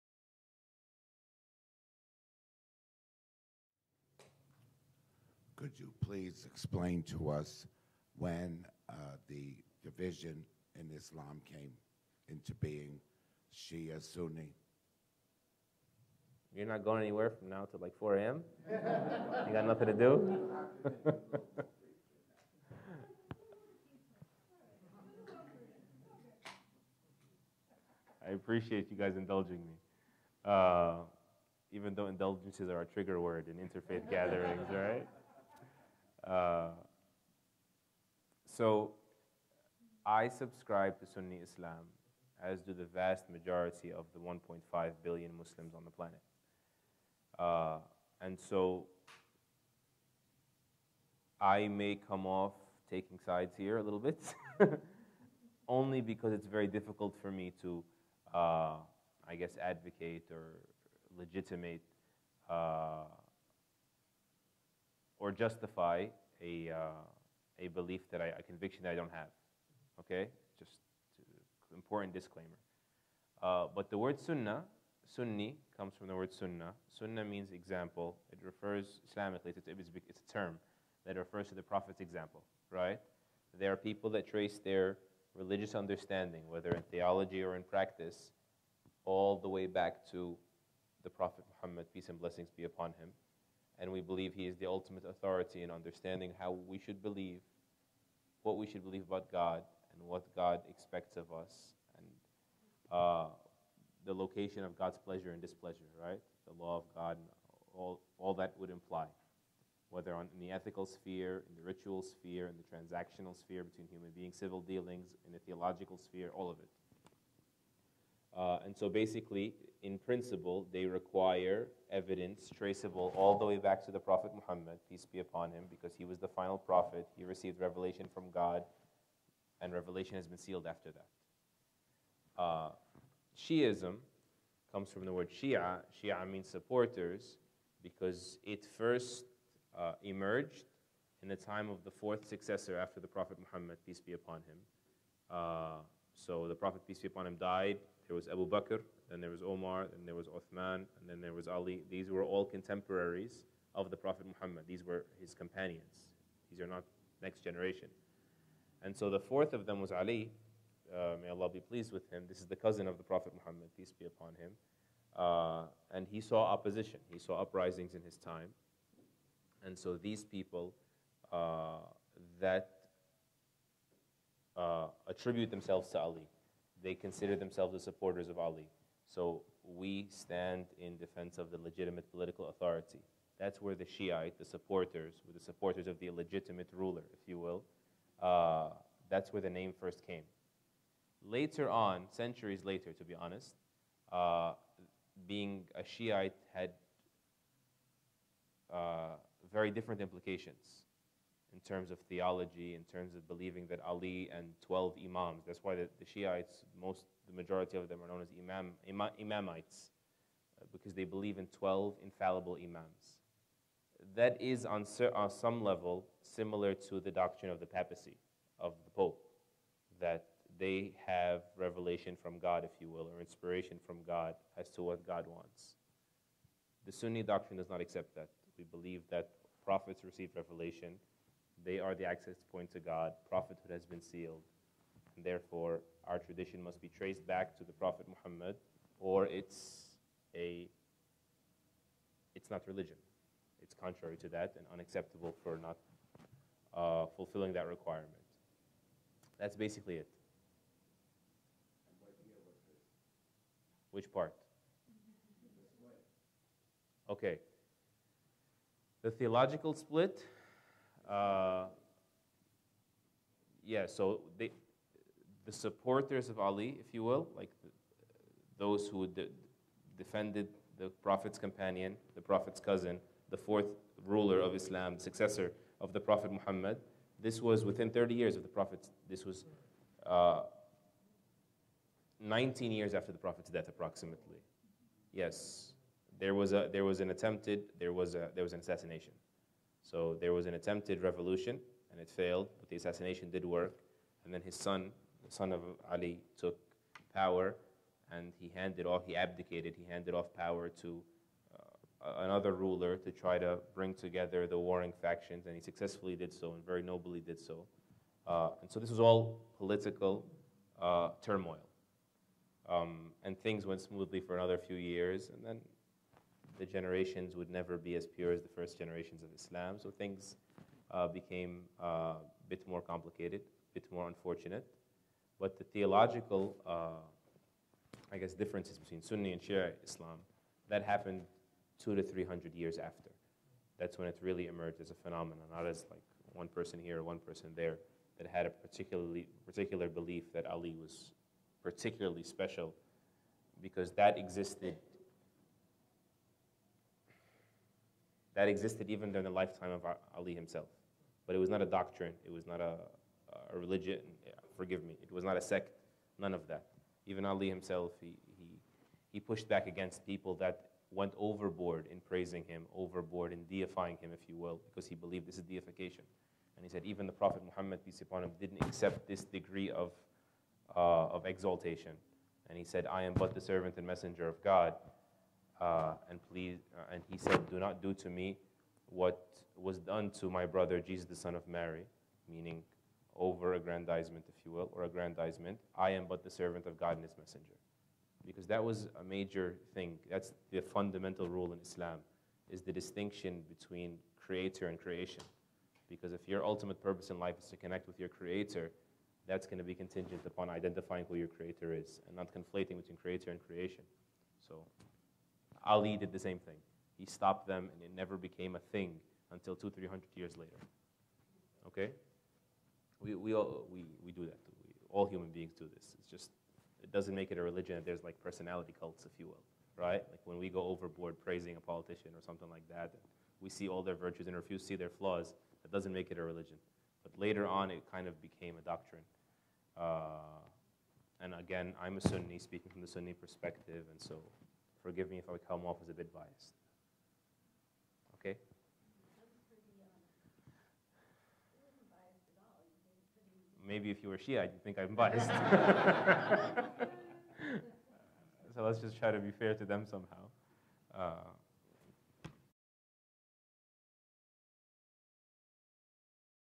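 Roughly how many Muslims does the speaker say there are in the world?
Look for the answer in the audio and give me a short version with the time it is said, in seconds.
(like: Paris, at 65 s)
1.5 billion, at 44 s.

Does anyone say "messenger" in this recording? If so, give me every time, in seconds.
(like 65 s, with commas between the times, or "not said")
373 s, 387 s.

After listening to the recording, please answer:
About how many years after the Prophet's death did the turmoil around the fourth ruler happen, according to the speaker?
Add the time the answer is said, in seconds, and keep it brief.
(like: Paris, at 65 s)
19, at 282 s.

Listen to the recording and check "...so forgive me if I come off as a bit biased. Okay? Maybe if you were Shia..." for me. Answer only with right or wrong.
right.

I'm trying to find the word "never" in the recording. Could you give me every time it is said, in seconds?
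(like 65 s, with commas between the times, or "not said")
317 s, 407 s.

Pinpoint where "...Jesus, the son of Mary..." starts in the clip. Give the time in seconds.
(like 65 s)
380 s.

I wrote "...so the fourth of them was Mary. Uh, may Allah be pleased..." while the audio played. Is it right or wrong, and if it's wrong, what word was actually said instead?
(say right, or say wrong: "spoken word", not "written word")
wrong: "Ali", not "Mary".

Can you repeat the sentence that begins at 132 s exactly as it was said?
Uh, Shiism comes from the word Shia.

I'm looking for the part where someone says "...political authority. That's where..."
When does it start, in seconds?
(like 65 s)
182 s.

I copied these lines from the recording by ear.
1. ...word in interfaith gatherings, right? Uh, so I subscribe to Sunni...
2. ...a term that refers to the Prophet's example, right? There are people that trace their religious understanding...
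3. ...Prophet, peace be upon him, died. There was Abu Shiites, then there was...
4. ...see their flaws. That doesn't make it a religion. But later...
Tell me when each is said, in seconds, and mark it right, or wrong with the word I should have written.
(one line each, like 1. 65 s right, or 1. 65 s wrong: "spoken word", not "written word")
1. 33 s right
2. 80 s right
3. 146 s wrong: "Bakr", not "Shiites"
4. 424 s right.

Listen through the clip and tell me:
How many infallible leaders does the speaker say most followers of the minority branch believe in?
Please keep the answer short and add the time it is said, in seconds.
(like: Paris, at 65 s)
12, at 211 s.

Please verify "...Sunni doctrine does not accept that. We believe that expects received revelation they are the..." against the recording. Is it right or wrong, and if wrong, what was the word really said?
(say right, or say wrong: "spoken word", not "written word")
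wrong: "prophets", not "expects".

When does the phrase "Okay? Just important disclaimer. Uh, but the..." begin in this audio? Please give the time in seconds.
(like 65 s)
69 s.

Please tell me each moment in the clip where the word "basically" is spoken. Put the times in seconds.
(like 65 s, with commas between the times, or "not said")
118 s, 249 s.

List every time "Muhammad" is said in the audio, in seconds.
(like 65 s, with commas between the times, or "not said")
91 s, 124 s, 143 s, 154 s, 163 s, 238 s, 276 s, 367 s.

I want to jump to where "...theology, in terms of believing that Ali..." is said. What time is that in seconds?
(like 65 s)
201 s.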